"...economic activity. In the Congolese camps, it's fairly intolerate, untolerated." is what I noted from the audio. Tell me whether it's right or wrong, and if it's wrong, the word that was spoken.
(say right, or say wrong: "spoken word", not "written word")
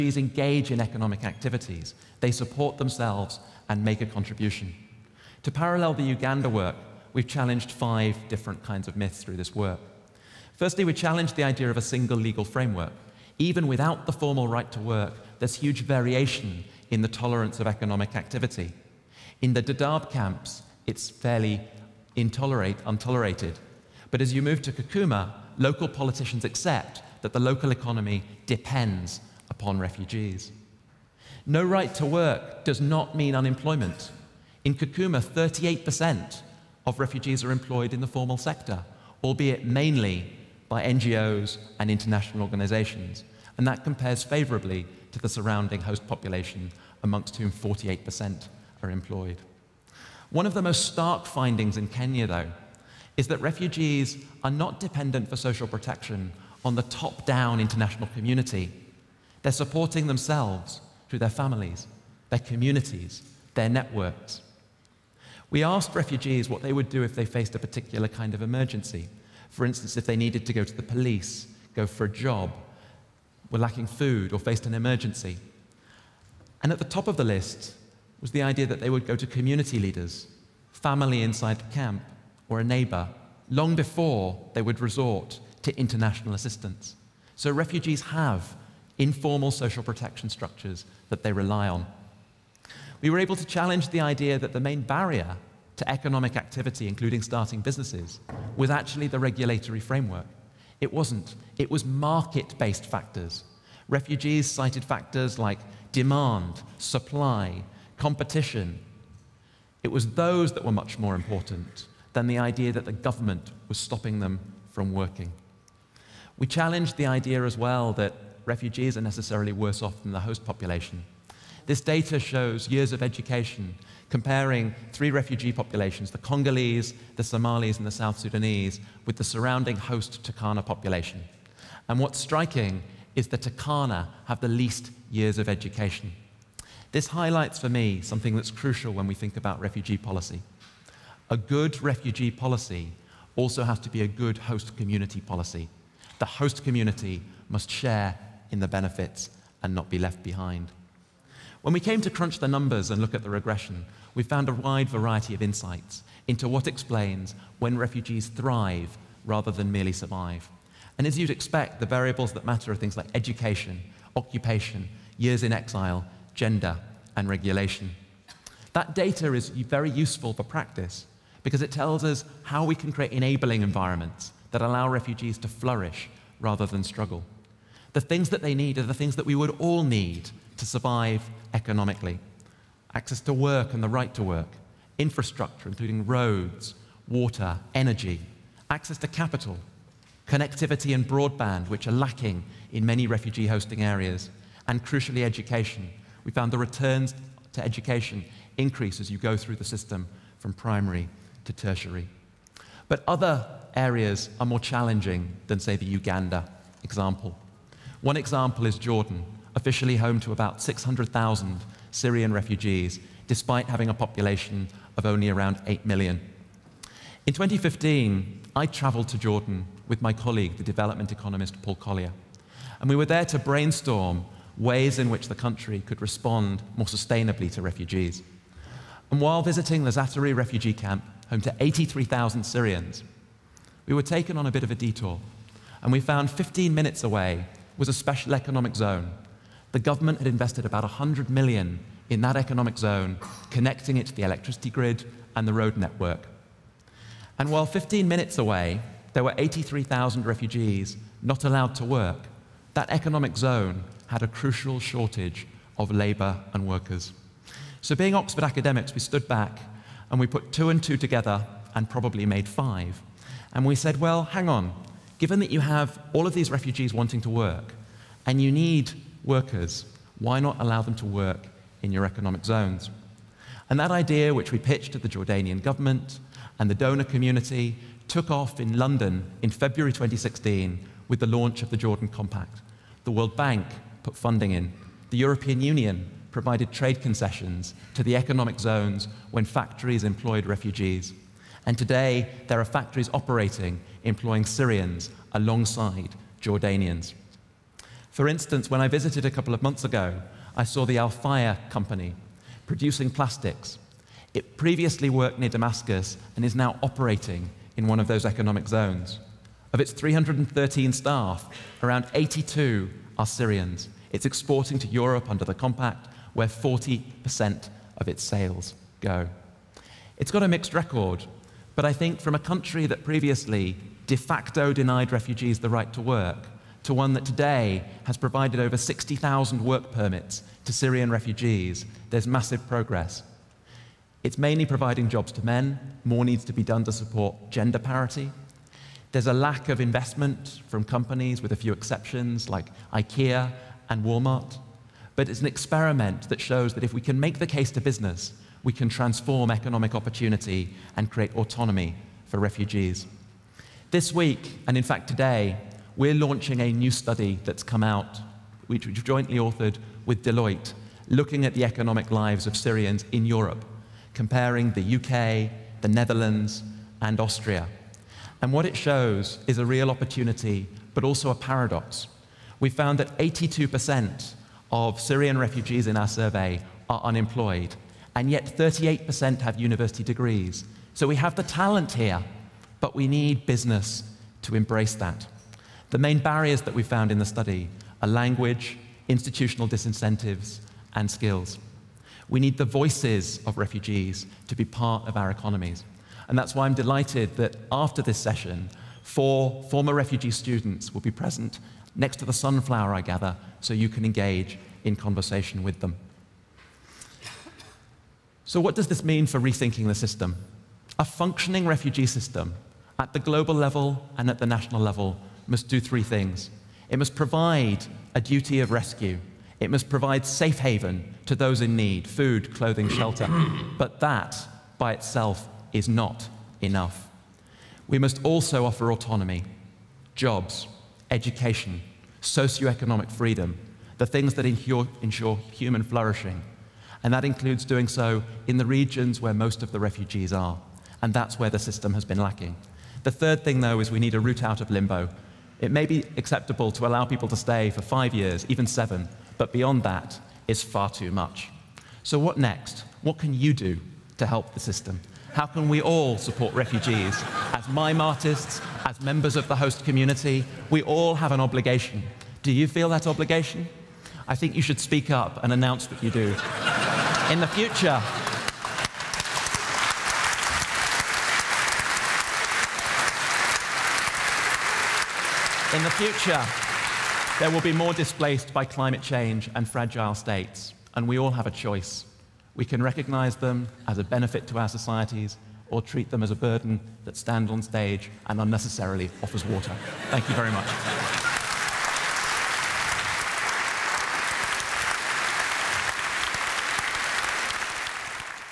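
wrong: "Dadaab", not "Congolese".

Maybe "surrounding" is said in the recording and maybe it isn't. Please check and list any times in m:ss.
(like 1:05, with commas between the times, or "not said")
0:45, 2:09.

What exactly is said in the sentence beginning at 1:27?
So refugees have informal social protection structures that they rely on.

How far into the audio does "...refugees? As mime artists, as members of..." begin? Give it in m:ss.
7:36.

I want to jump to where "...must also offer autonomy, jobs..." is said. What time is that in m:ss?
7:07.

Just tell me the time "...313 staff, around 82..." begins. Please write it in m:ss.
5:09.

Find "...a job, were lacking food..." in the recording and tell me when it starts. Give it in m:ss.
1:12.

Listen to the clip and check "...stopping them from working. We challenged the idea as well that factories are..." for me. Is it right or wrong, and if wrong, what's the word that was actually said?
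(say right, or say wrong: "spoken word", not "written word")
wrong: "refugees", not "factories".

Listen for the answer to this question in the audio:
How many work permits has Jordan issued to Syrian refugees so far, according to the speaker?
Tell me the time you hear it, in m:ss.
5:28.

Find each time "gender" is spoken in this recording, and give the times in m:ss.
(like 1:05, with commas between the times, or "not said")
2:46, 5:37.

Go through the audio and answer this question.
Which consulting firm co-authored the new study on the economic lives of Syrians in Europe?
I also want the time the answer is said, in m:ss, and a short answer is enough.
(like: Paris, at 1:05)
Deloitte, at 6:00.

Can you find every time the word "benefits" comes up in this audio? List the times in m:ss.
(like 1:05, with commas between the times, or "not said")
2:28, 8:04.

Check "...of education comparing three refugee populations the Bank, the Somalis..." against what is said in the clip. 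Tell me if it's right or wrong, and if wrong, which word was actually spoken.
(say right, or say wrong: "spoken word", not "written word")
wrong: "Congolese", not "Bank".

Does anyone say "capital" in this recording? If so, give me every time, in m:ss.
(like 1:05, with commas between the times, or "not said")
3:09.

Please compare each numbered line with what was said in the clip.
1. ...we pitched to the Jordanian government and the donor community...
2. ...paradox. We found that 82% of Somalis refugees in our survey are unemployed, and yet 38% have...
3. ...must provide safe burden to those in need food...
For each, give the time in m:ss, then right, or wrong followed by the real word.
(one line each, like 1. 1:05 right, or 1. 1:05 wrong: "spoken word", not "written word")
1. 4:34 right
2. 6:11 wrong: "Syrian", not "Somalis"
3. 6:59 wrong: "haven", not "burden".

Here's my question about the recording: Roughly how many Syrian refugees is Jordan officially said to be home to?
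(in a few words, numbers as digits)
600,000.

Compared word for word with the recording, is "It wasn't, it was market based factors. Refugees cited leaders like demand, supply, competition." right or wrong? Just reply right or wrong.
wrong.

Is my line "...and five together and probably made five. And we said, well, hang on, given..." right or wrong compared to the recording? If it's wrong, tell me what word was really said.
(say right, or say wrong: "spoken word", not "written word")
wrong: "two", not "five".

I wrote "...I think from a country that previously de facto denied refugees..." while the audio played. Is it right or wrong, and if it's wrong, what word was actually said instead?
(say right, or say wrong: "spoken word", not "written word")
right.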